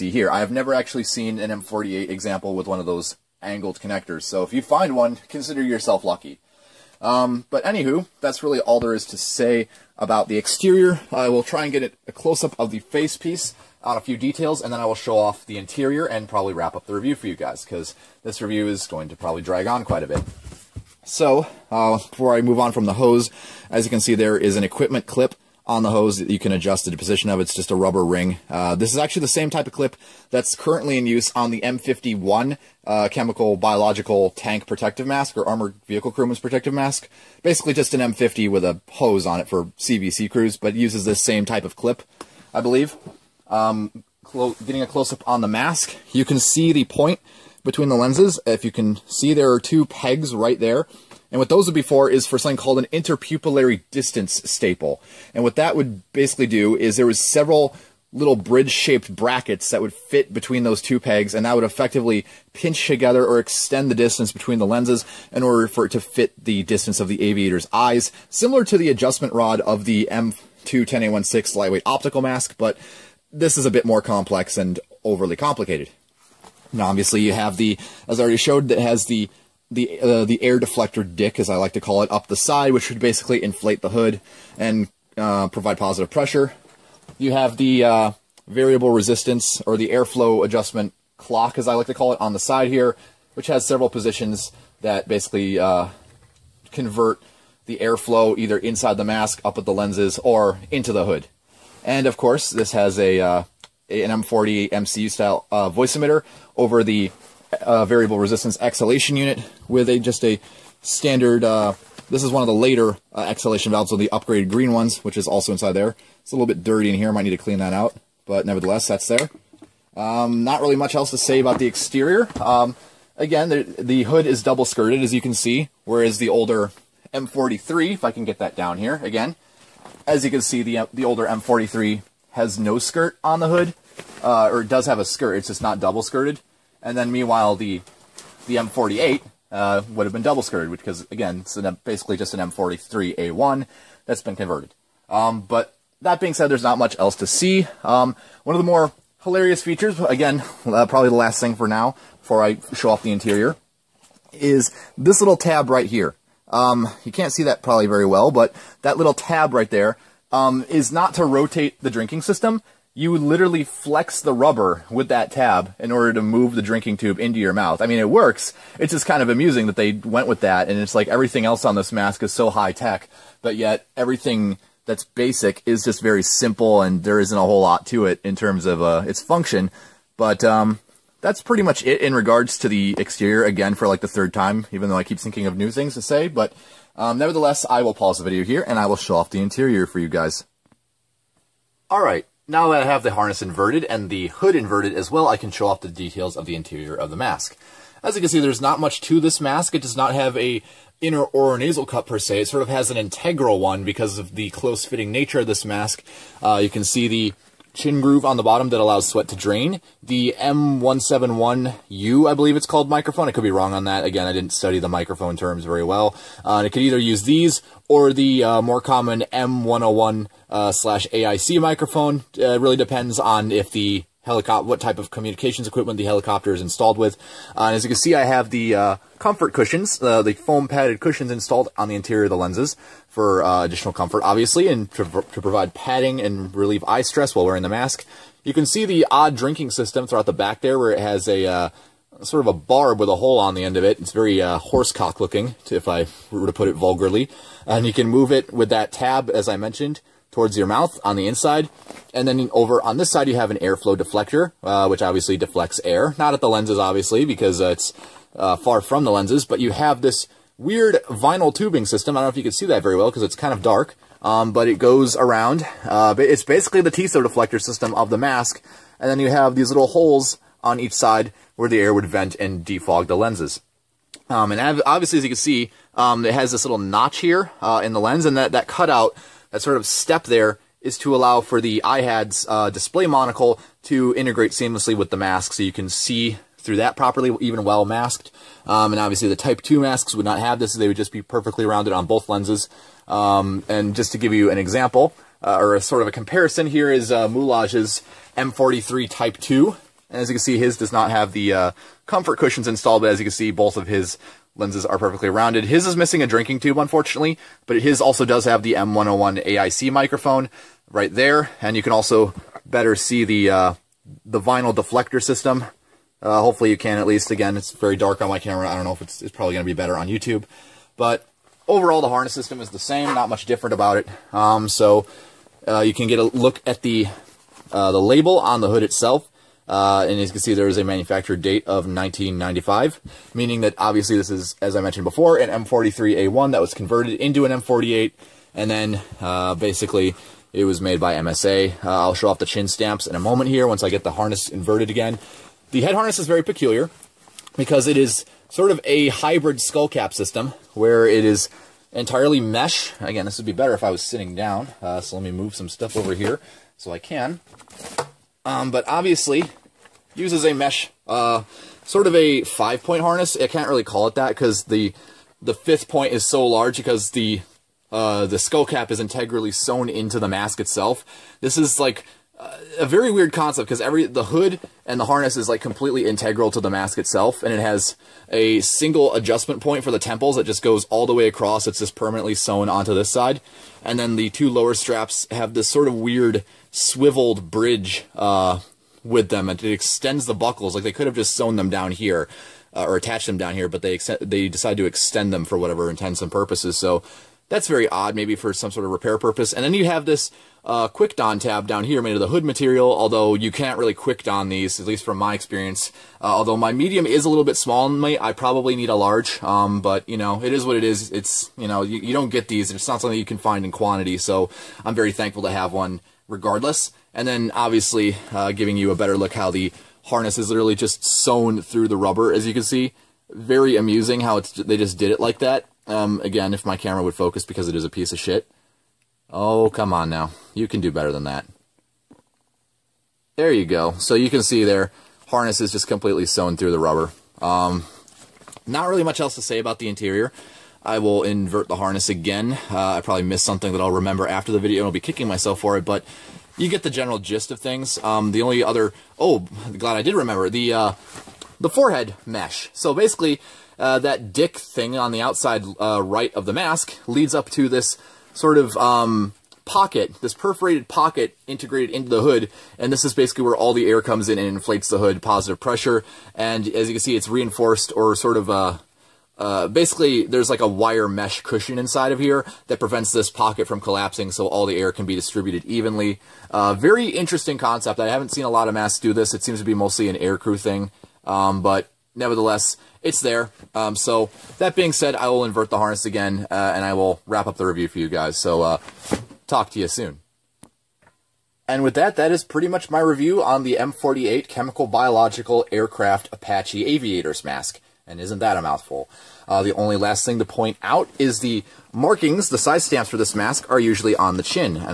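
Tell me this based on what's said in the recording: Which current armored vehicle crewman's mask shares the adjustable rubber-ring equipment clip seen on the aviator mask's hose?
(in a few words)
M51.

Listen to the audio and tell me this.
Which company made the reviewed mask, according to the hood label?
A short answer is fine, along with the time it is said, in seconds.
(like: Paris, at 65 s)
MSA, at 341 s.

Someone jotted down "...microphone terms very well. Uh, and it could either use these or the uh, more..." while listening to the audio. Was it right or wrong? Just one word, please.
right.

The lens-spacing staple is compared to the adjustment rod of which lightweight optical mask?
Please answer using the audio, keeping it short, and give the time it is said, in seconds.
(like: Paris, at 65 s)
M210A16, at 70 s.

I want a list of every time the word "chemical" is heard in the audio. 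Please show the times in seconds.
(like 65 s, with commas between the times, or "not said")
33 s, 494 s.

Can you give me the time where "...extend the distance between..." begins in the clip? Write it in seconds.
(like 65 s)
63 s.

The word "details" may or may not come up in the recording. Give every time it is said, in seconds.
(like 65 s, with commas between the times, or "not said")
14 s, 195 s.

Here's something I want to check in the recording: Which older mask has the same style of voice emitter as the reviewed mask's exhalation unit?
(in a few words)
M40.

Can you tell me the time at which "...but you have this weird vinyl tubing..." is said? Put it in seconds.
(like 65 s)
259 s.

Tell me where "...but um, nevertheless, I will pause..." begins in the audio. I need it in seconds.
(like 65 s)
186 s.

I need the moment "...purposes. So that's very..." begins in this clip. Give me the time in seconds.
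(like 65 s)
396 s.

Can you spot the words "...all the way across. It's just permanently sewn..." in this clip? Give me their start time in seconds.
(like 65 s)
380 s.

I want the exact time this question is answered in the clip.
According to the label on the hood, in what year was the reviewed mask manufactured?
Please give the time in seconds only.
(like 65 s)
331 s.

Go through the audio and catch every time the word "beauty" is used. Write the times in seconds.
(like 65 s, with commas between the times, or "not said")
not said.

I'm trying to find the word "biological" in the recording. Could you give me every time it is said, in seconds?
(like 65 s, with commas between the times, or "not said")
33 s, 494 s.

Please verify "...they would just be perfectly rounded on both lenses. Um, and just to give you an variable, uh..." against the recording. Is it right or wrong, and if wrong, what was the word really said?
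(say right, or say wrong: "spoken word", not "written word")
wrong: "example", not "variable".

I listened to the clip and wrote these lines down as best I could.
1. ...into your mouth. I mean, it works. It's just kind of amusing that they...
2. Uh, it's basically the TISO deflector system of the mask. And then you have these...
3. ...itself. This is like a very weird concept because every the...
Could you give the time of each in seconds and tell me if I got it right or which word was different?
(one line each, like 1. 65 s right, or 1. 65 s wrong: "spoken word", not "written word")
1. 167 s right
2. 265 s right
3. 370 s right.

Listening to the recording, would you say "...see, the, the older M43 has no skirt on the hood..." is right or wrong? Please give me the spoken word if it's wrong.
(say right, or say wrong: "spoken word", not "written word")
right.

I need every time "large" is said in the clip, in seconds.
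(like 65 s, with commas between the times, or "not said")
366 s, 408 s.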